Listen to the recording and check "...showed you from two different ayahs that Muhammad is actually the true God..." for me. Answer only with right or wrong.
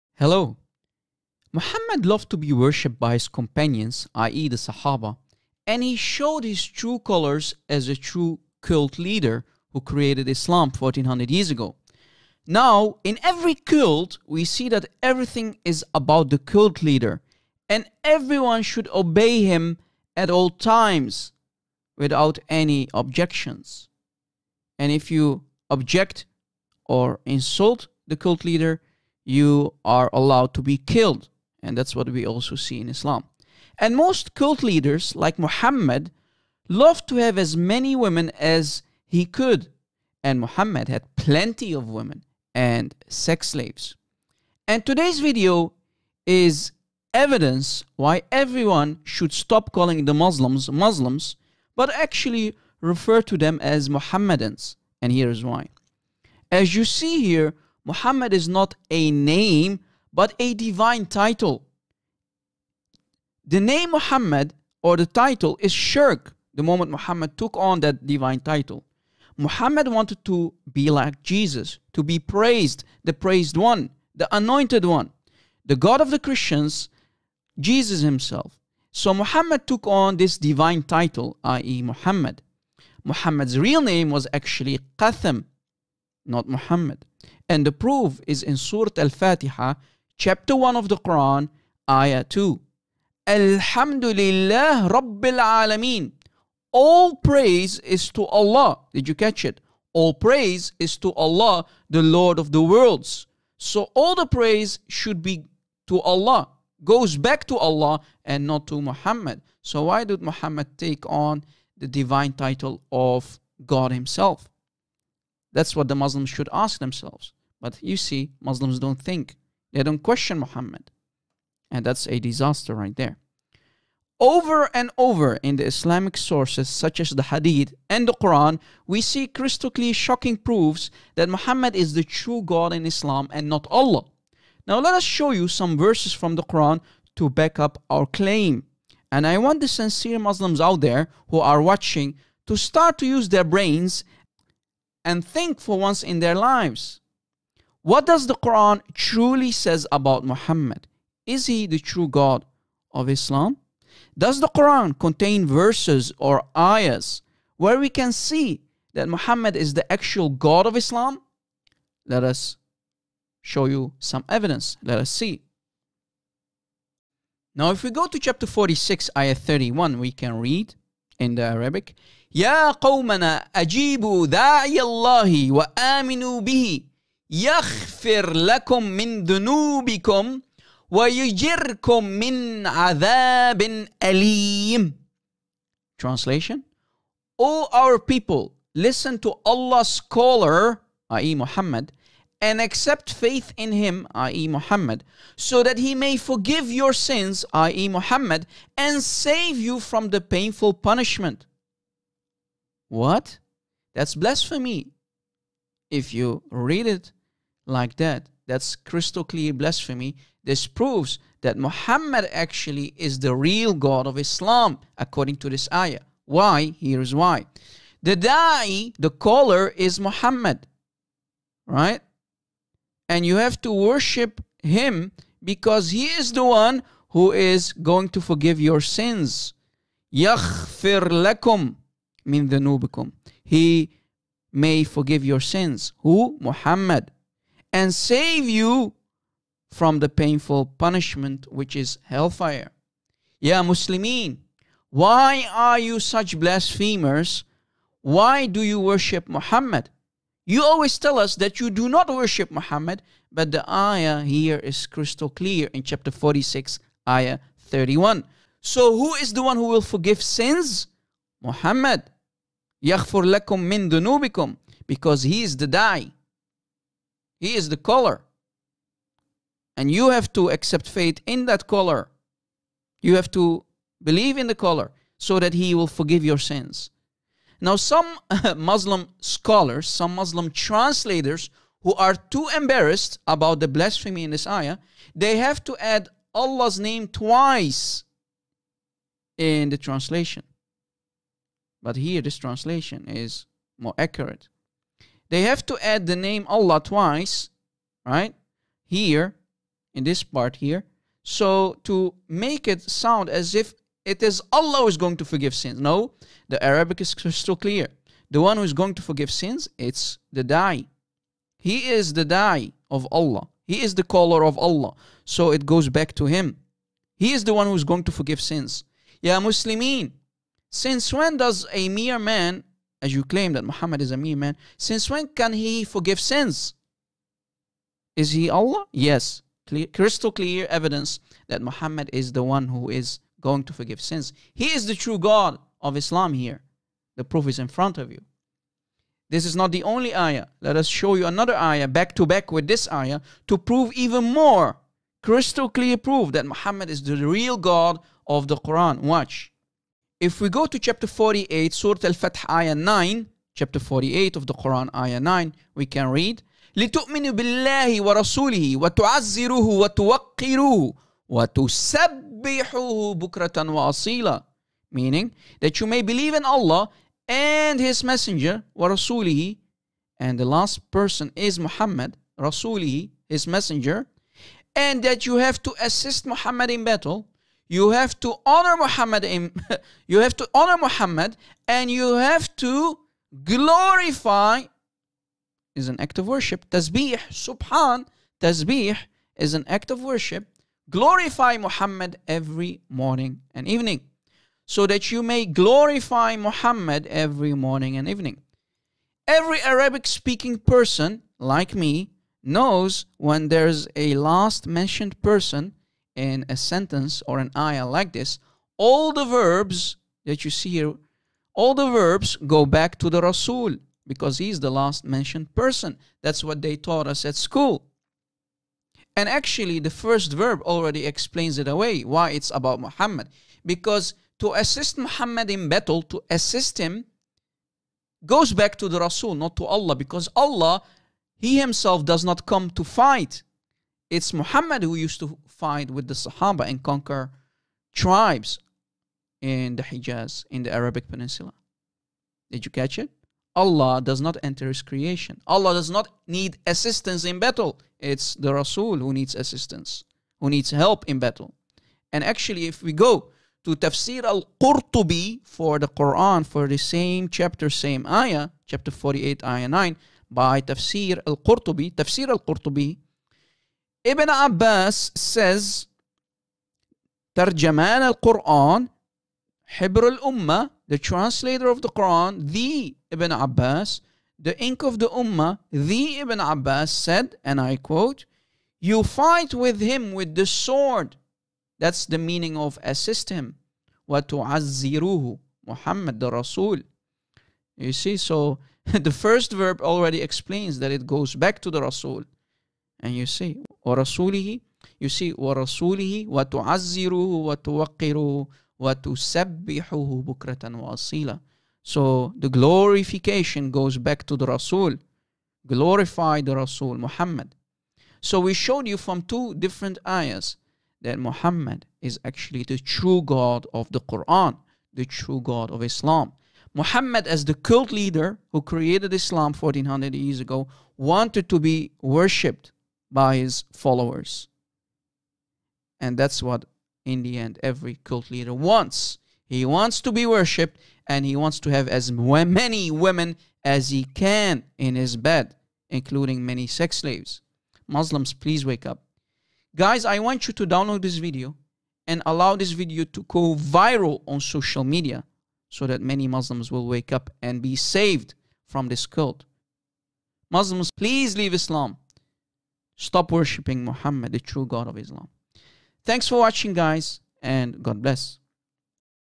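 right.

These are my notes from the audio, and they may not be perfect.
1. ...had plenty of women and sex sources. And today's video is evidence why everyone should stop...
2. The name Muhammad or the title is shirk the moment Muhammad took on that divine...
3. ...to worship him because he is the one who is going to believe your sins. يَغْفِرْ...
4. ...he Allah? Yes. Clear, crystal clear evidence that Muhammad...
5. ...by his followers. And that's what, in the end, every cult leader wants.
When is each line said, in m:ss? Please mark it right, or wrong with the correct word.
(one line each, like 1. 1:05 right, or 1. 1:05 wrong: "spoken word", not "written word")
1. 0:40 wrong: "slaves", not "sources"
2. 1:03 right
3. 3:43 wrong: "forgive", not "believe"
4. 5:28 right
5. 8:43 right.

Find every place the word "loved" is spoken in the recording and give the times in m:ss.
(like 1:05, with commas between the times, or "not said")
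0:02, 0:36.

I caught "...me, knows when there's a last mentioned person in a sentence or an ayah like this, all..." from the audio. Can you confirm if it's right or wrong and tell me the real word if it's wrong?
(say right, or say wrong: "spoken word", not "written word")
right.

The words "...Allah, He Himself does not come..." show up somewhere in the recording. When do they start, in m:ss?
7:10.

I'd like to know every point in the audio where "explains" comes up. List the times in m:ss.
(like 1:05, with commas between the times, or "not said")
7:01, 8:10.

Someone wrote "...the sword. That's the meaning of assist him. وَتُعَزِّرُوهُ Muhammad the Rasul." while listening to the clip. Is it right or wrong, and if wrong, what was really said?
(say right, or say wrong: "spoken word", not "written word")
right.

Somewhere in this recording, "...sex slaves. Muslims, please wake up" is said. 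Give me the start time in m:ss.
8:56.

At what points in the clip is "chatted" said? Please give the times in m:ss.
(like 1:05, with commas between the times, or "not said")
not said.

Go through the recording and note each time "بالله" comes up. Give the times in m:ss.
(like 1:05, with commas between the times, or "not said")
5:57.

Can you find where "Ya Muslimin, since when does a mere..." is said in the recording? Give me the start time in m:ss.
5:19.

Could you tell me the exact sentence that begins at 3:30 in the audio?
This proves that Muhammad actually is the real God of Islam, according to this ayah.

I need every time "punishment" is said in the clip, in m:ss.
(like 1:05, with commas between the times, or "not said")
3:20, 4:00.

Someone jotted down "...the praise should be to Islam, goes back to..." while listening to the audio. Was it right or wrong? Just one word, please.
wrong.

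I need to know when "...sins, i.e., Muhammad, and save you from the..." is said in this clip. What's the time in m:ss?
3:16.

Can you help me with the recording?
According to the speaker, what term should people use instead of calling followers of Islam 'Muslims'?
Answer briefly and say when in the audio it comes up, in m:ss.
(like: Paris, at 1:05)
Mohammedans, at 0:53.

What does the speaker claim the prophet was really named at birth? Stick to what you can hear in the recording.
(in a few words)
Qatham.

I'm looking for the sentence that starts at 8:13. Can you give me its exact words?
And you see, وَرَسُولِهِ You see, وَرَسُولِهِ وَتُعَزِّرُهُ وَتُوَقِّرُهُ وَتُسَبِّحُهُ بُكْرَةً وَأَصِيلًا So the glorification goes back to the Rasul.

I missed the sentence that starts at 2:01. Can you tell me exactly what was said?
And that's a disaster right there.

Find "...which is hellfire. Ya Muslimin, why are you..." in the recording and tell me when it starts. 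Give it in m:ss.
4:01.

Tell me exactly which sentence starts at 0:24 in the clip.
And if you object or insult the cult leader, you are allowed to be killed.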